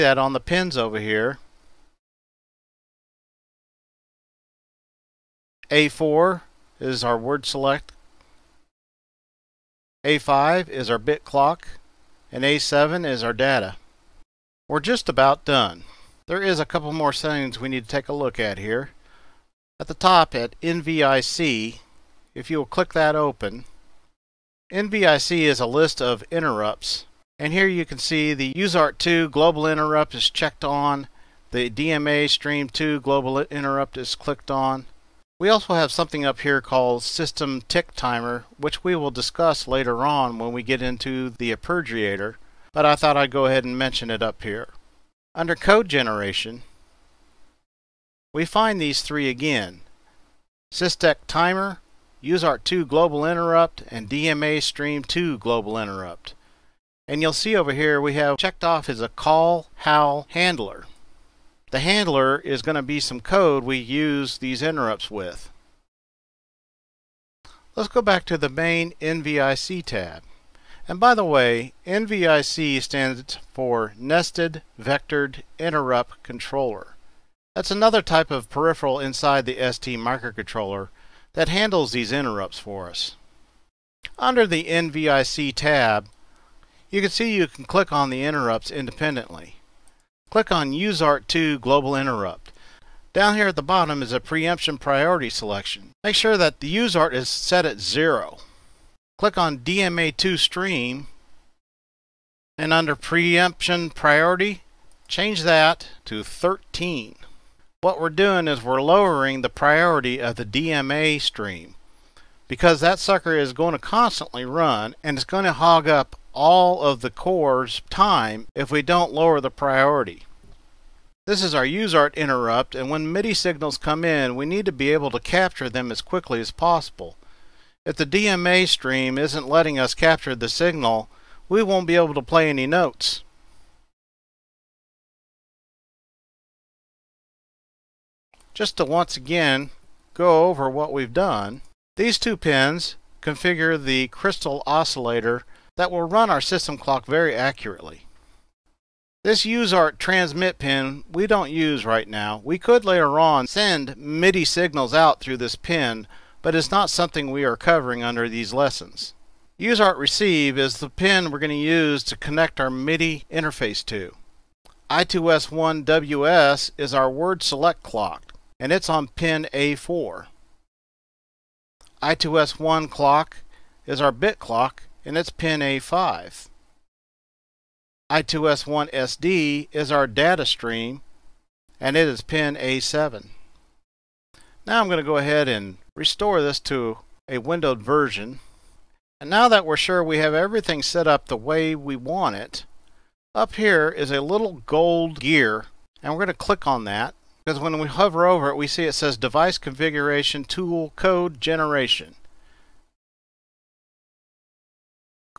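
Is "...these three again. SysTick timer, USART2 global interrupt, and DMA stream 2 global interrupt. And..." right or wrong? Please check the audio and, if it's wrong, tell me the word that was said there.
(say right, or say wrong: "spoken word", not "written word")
right.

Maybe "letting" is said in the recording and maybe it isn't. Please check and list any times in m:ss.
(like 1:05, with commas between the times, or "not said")
2:09.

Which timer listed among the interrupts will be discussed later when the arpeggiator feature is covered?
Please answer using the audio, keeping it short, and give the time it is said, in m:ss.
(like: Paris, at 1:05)
System Tick Timer, at 0:37.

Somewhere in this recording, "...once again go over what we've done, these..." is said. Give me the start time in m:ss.
2:18.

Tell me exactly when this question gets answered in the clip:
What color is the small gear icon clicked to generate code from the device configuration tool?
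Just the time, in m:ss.
3:14.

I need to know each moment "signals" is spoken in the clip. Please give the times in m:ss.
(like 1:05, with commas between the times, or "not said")
2:03, 2:10, 2:34.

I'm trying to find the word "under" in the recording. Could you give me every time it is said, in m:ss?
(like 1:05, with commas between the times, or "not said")
0:45, 1:24, 1:42, 2:38.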